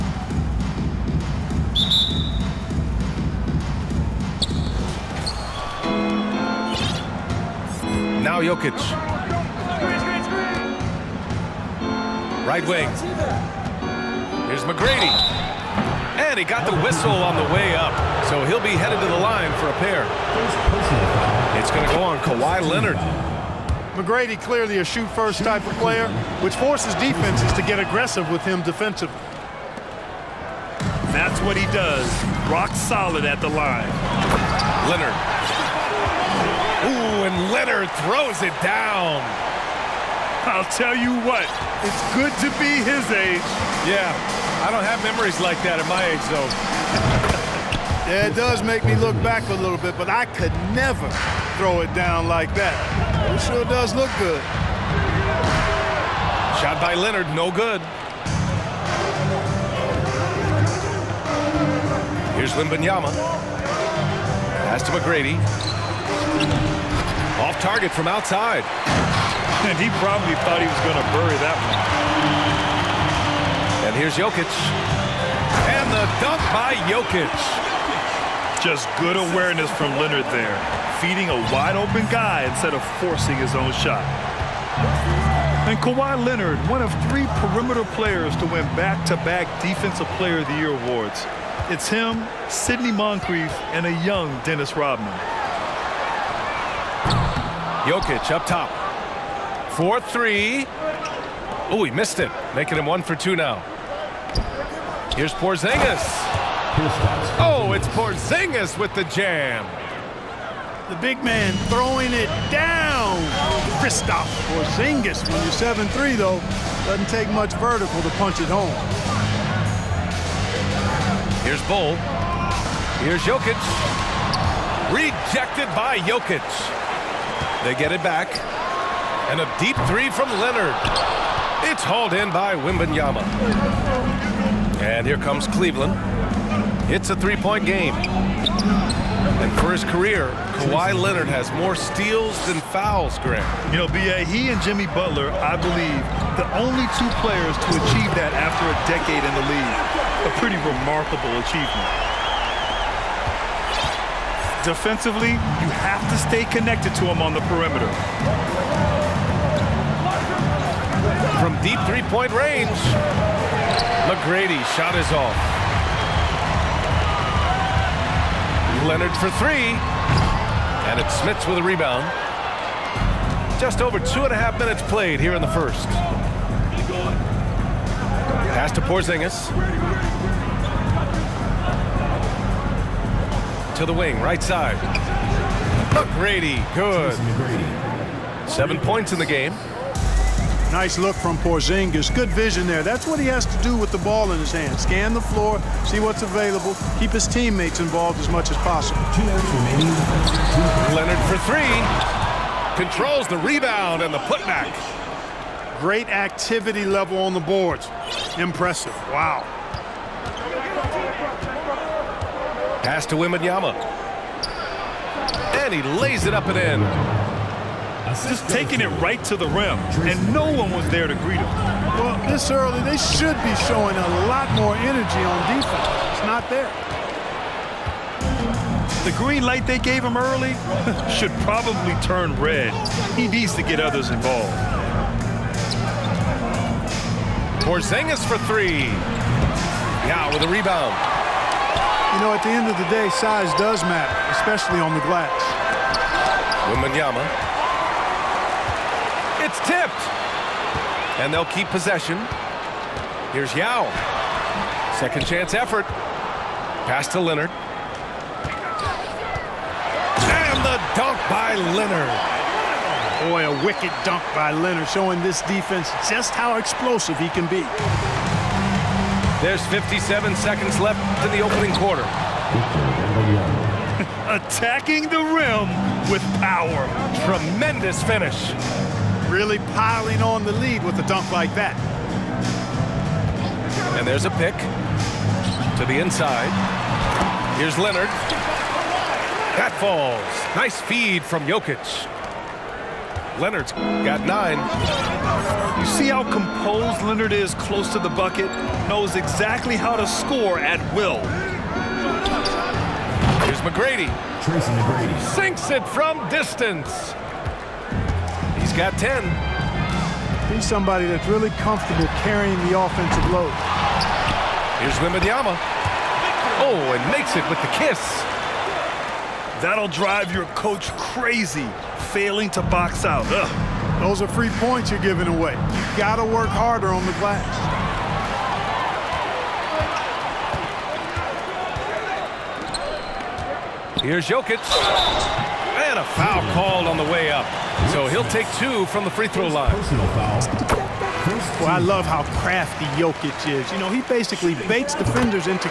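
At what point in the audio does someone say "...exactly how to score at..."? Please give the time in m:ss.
4:59.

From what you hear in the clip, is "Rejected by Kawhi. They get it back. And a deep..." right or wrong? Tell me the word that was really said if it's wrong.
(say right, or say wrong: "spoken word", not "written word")
wrong: "Jokic", not "Kawhi".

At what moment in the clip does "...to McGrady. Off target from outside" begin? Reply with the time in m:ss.
1:04.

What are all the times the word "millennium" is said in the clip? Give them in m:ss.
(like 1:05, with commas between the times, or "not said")
not said.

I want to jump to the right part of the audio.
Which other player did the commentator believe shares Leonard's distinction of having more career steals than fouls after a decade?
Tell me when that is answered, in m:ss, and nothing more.
2:24.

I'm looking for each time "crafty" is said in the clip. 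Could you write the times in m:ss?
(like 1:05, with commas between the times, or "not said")
5:42.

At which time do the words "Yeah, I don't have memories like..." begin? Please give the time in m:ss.
0:43.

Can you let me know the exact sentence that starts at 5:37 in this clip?
So he'll take two from the free throw line.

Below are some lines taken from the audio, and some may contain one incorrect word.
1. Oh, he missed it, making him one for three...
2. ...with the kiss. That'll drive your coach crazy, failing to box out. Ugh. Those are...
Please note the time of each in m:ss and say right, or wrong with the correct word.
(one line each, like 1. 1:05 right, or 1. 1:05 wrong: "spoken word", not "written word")
1. 1:41 wrong: "two", not "three"
2. 5:17 right.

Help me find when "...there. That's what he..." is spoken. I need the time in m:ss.
3:12.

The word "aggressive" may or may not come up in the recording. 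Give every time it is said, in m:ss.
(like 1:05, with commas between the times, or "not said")
0:27.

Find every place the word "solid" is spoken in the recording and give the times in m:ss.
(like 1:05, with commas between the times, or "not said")
0:32.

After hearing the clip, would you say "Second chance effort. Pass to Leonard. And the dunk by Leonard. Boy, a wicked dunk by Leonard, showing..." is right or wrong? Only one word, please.
right.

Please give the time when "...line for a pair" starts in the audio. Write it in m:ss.
0:19.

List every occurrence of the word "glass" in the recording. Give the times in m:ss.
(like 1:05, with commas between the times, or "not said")
4:05, 5:27.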